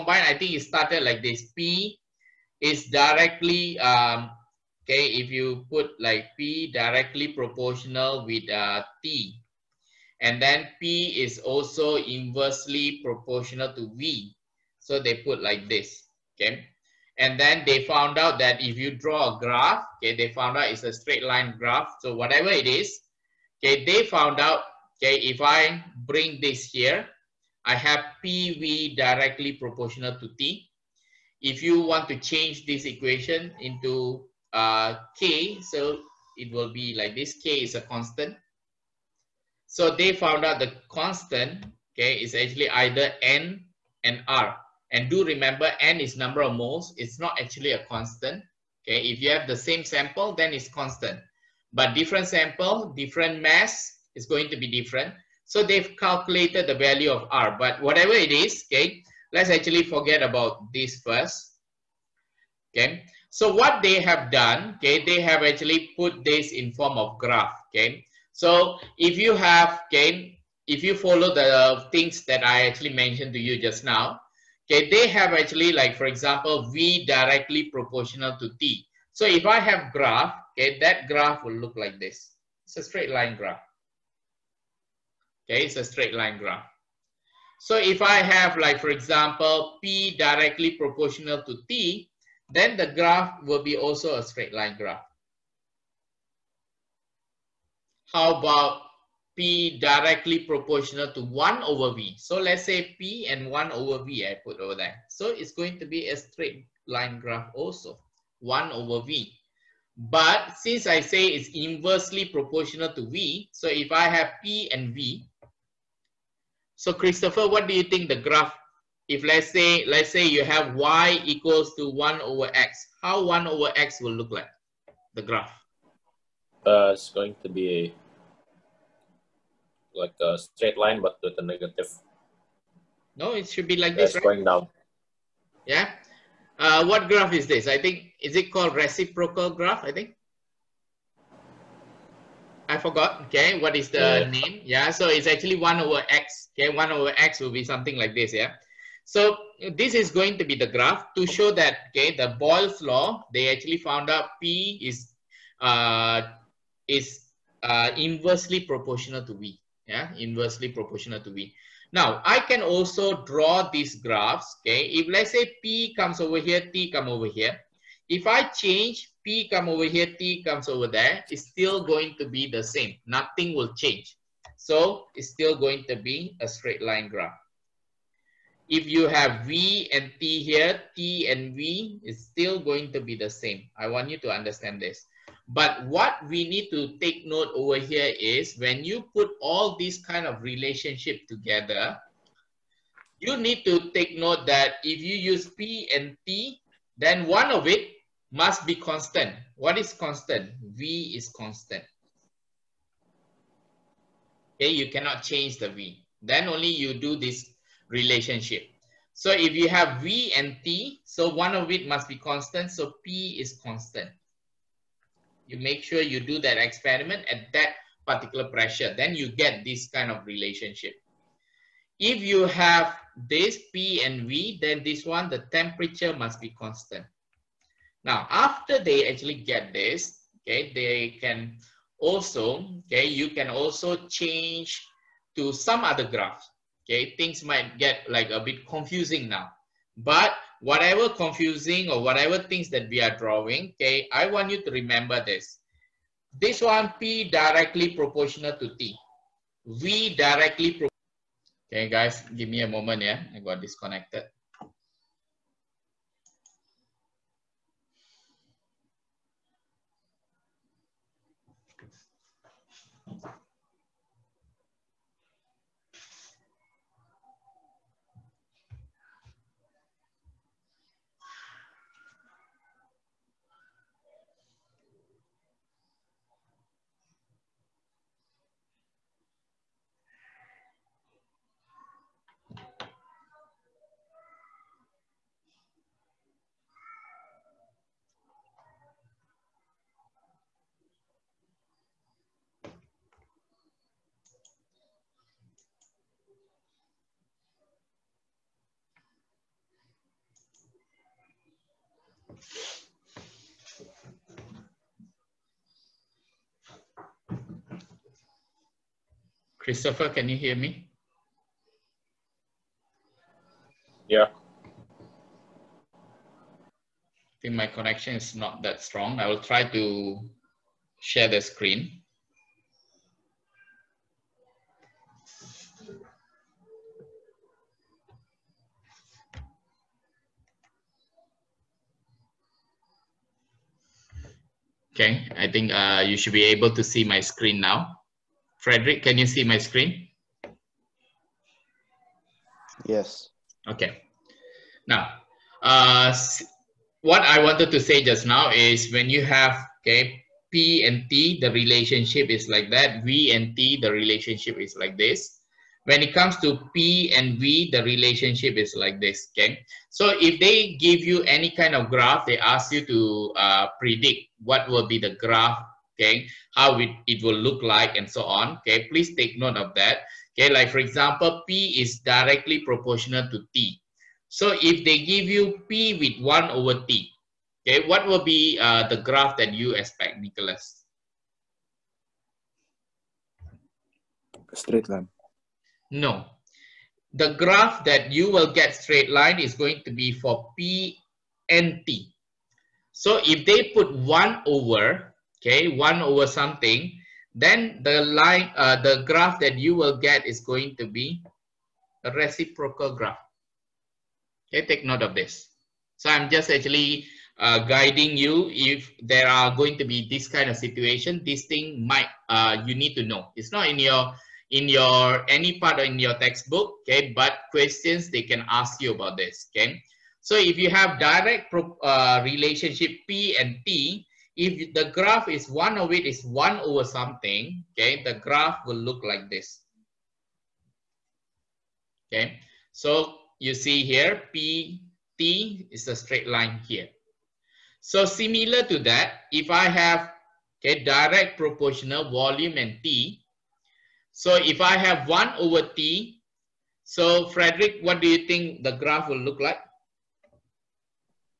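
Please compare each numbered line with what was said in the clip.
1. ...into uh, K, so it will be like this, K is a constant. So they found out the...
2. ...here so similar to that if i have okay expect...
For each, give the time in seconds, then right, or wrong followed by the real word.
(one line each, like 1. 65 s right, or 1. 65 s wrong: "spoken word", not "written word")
1. 33 s right
2. 436 s wrong: "direct", not "expect".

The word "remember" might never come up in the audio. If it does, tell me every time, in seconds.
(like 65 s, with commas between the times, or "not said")
45 s, 244 s.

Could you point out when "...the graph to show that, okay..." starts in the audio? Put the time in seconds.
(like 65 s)
150 s.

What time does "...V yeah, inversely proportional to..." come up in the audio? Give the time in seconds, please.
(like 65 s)
159 s.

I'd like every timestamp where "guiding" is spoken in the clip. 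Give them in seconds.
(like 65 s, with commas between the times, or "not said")
407 s.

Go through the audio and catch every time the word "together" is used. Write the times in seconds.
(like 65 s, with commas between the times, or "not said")
191 s.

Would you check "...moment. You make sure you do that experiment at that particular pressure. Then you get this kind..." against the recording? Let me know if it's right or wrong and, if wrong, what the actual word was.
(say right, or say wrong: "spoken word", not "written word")
wrong: "constant", not "moment".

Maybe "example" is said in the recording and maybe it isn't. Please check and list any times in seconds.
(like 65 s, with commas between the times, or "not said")
76 s, 88 s, 370 s.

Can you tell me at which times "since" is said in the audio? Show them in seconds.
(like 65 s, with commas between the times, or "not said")
110 s.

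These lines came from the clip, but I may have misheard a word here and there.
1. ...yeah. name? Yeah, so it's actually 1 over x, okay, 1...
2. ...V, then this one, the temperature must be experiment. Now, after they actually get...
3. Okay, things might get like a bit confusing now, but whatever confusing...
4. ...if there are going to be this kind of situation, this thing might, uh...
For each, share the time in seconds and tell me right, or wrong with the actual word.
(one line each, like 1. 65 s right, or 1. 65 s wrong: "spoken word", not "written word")
1. 144 s right
2. 224 s wrong: "constant", not "experiment"
3. 236 s right
4. 408 s right.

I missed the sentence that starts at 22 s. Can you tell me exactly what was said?
So whatever it is, okay, they found out, okay, if I bring this here, I have PV directly proportional to T.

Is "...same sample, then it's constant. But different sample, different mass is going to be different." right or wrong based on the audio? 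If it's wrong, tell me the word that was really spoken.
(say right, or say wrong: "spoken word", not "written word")
right.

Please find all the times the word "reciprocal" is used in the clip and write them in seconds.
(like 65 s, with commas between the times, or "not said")
138 s, 402 s.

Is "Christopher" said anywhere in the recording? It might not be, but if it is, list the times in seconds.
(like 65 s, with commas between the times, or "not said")
116 s, 309 s.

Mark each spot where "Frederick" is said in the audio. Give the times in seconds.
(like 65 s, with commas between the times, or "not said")
338 s, 447 s.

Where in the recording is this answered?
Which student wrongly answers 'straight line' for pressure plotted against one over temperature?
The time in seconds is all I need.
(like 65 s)
380 s.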